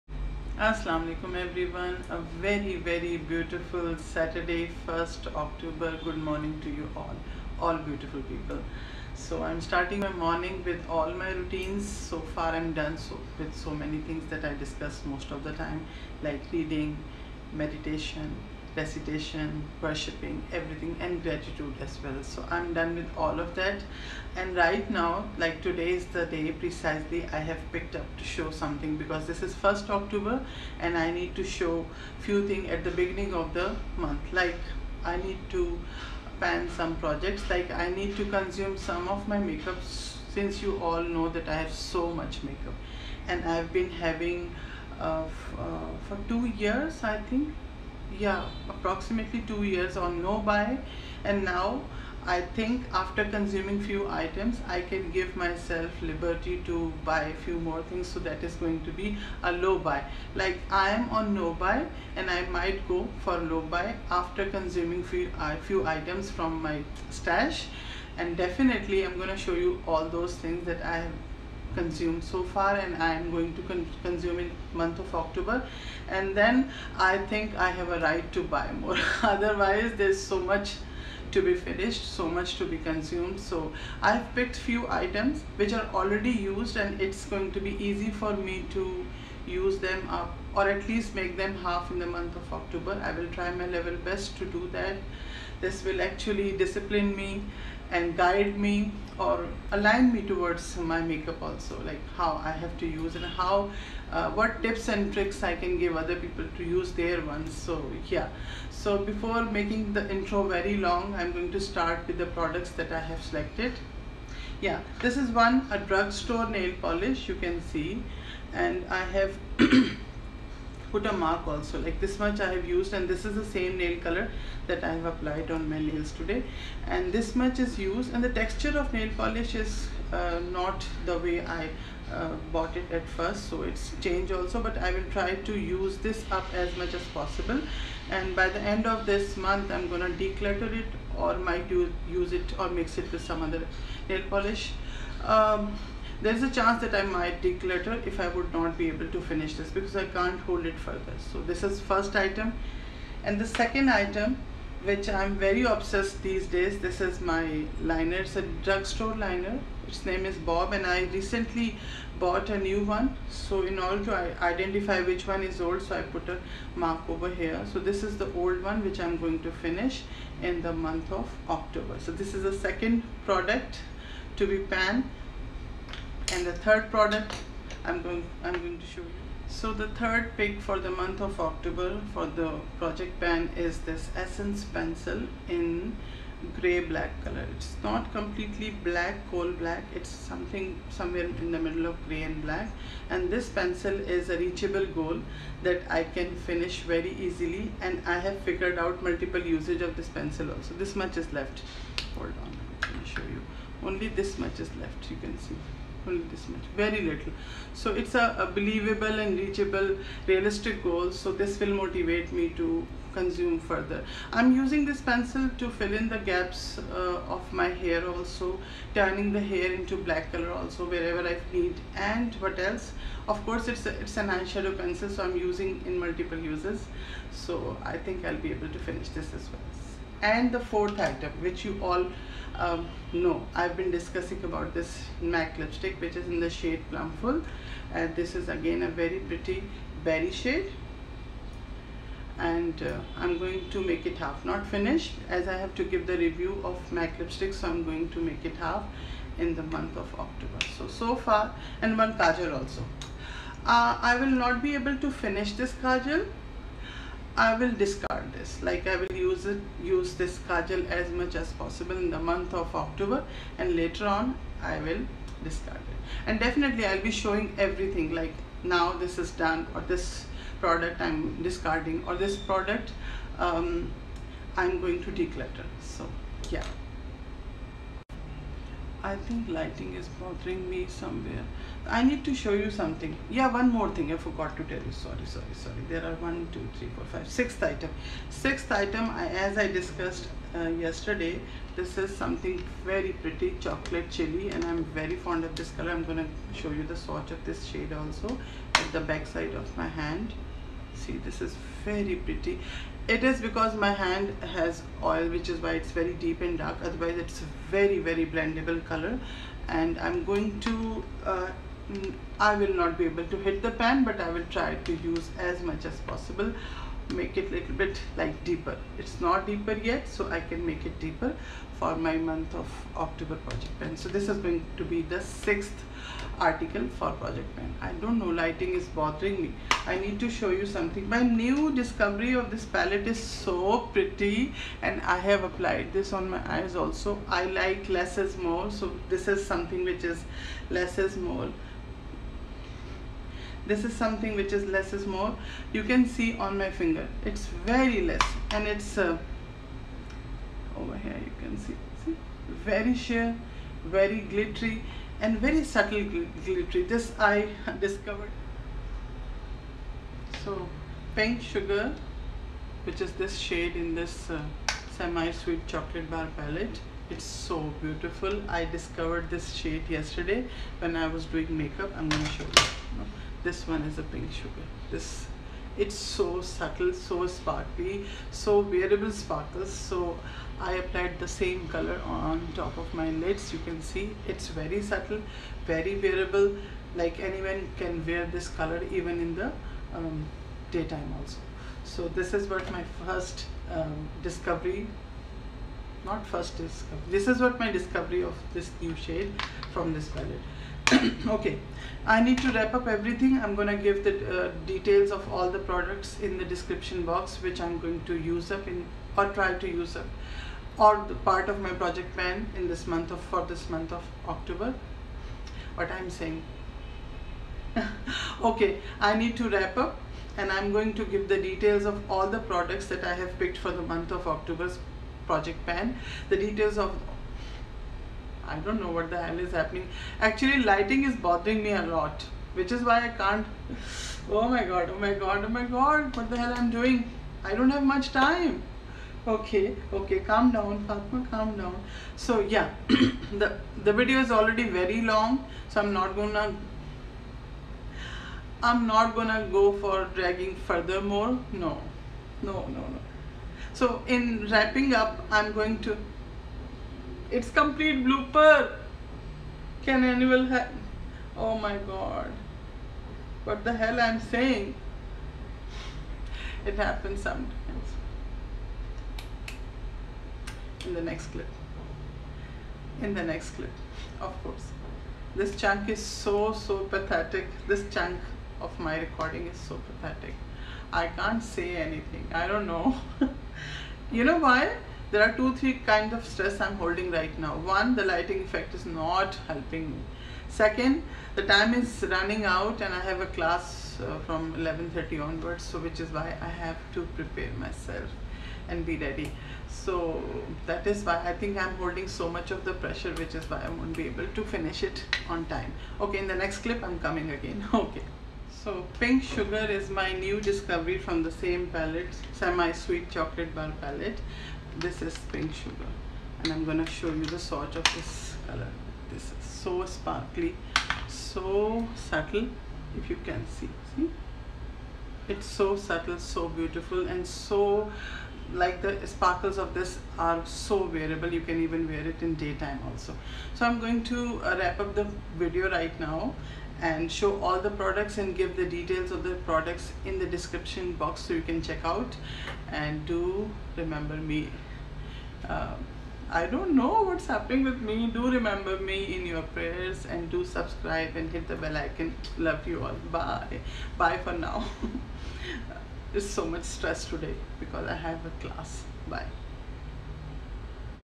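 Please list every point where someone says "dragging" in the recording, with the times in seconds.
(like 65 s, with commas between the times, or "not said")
450 s.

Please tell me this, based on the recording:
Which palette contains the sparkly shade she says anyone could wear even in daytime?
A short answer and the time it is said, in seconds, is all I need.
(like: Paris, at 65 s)
Semi-Sweet Chocolate Bar, at 364 s.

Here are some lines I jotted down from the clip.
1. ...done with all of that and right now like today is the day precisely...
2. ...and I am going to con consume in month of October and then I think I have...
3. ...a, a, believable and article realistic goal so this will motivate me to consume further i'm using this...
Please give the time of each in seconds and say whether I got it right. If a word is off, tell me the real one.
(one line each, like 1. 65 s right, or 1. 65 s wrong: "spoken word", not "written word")
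1. 22 s right
2. 72 s right
3. 208 s wrong: "reachable", not "article".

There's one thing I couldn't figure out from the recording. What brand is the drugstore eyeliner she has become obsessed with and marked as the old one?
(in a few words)
Bob.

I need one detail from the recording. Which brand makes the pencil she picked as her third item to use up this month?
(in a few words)
Essence.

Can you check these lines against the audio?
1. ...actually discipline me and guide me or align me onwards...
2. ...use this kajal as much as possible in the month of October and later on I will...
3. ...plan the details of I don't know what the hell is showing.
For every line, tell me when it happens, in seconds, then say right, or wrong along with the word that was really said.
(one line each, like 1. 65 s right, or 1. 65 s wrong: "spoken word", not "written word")
1. 96 s wrong: "towards", not "onwards"
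2. 259 s right
3. 425 s wrong: "happening", not "showing".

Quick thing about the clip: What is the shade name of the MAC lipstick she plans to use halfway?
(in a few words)
Plumful.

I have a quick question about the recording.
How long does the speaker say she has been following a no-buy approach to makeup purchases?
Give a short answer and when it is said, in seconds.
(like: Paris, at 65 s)
2 years, at 48 s.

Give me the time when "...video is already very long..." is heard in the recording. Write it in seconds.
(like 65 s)
443 s.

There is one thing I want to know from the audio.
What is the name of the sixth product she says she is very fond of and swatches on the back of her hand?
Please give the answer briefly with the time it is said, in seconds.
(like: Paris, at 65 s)
Chocolate Chili, at 293 s.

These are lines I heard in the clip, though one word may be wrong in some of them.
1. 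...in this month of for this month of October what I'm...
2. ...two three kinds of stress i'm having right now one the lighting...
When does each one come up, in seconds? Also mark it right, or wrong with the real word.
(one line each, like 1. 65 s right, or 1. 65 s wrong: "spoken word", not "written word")
1. 412 s right
2. 485 s wrong: "holding", not "having".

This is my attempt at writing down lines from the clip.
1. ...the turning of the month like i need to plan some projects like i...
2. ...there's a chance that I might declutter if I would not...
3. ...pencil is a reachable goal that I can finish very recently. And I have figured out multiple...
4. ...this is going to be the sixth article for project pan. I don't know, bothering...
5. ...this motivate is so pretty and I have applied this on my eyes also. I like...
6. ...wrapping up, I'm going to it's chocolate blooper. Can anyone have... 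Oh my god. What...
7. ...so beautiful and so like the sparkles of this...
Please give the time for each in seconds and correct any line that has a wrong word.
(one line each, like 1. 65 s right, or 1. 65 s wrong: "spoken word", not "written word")
1. 32 s wrong: "beginning", not "turning"
2. 146 s right
3. 193 s wrong: "easily", not "recently"
4. 324 s wrong: "lighting", not "bothering"
5. 332 s wrong: "palette", not "motivate"
6. 454 s wrong: "complete", not "chocolate"
7. 526 s right.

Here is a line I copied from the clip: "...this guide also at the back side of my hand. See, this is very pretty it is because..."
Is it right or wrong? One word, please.
wrong.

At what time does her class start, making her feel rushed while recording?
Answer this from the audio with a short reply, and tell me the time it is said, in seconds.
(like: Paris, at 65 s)
11:30, at 494 s.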